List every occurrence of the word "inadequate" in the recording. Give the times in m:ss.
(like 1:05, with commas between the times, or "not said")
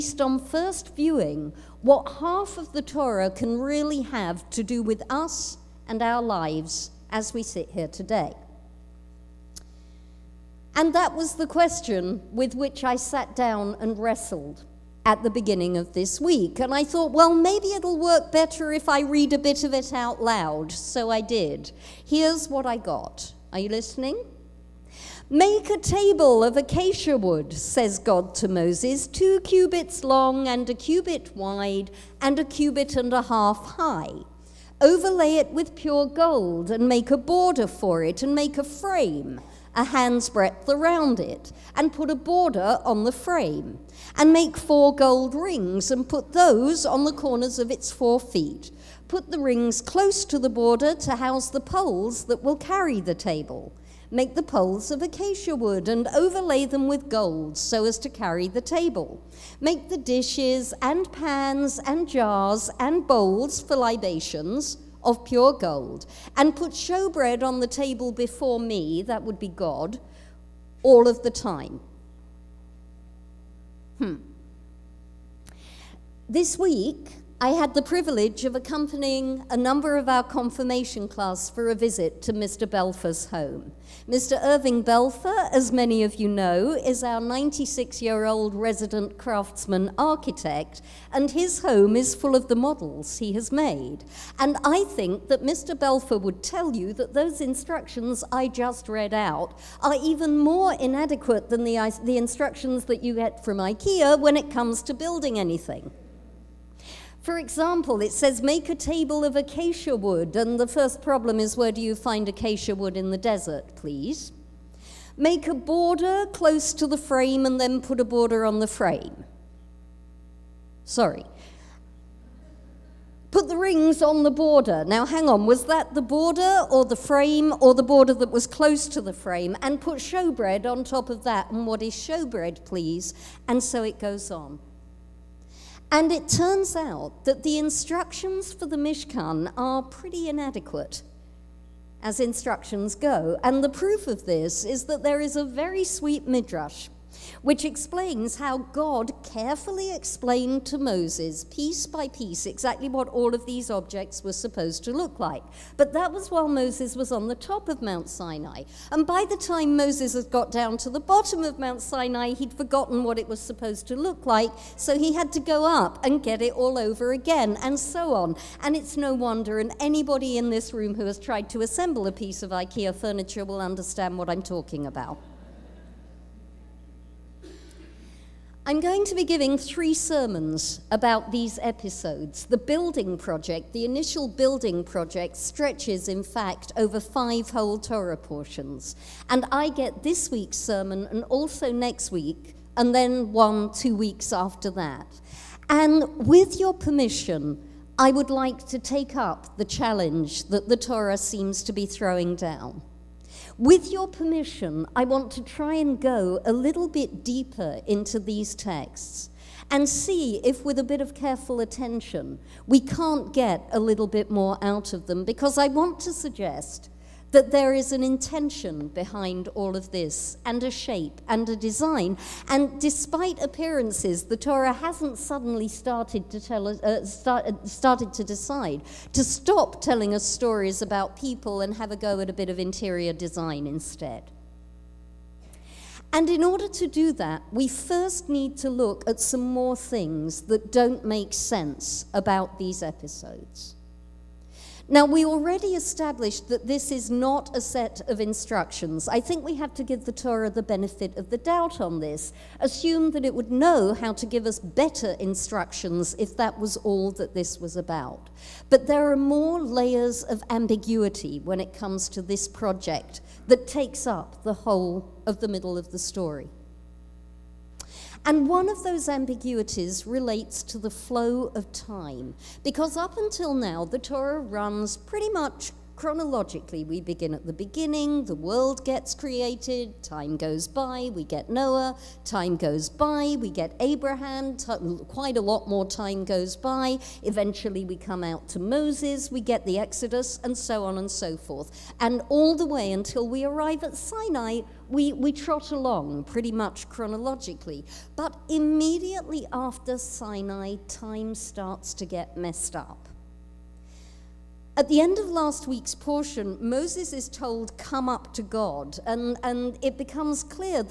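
1:40, 2:20.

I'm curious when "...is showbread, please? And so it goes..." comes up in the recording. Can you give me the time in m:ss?
2:11.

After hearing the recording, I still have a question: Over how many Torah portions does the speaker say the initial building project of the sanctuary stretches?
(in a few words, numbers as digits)
5.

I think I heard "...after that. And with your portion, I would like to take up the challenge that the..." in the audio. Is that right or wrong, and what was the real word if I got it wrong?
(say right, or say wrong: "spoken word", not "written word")
wrong: "permission", not "portion".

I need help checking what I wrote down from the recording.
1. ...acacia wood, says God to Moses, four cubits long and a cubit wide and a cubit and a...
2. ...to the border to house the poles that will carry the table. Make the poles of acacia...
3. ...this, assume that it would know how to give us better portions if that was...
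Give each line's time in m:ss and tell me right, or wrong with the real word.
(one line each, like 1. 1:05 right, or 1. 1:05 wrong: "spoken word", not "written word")
1. 0:26 wrong: "two", not "four"
2. 0:50 right
3. 4:11 wrong: "instructions", not "portions".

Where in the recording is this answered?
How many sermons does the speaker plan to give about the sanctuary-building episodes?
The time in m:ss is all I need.
2:59.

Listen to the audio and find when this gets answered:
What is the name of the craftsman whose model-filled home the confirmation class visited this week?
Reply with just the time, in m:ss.
1:24.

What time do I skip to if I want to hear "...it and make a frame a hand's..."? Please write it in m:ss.
0:38.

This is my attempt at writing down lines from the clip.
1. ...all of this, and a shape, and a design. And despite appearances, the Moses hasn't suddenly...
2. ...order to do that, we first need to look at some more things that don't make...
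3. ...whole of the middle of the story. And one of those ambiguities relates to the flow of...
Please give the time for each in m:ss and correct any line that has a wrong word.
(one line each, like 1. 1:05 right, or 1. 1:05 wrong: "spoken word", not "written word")
1. 3:39 wrong: "Torah", not "Moses"
2. 3:56 right
3. 4:24 right.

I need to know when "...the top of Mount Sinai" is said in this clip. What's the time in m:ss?
2:37.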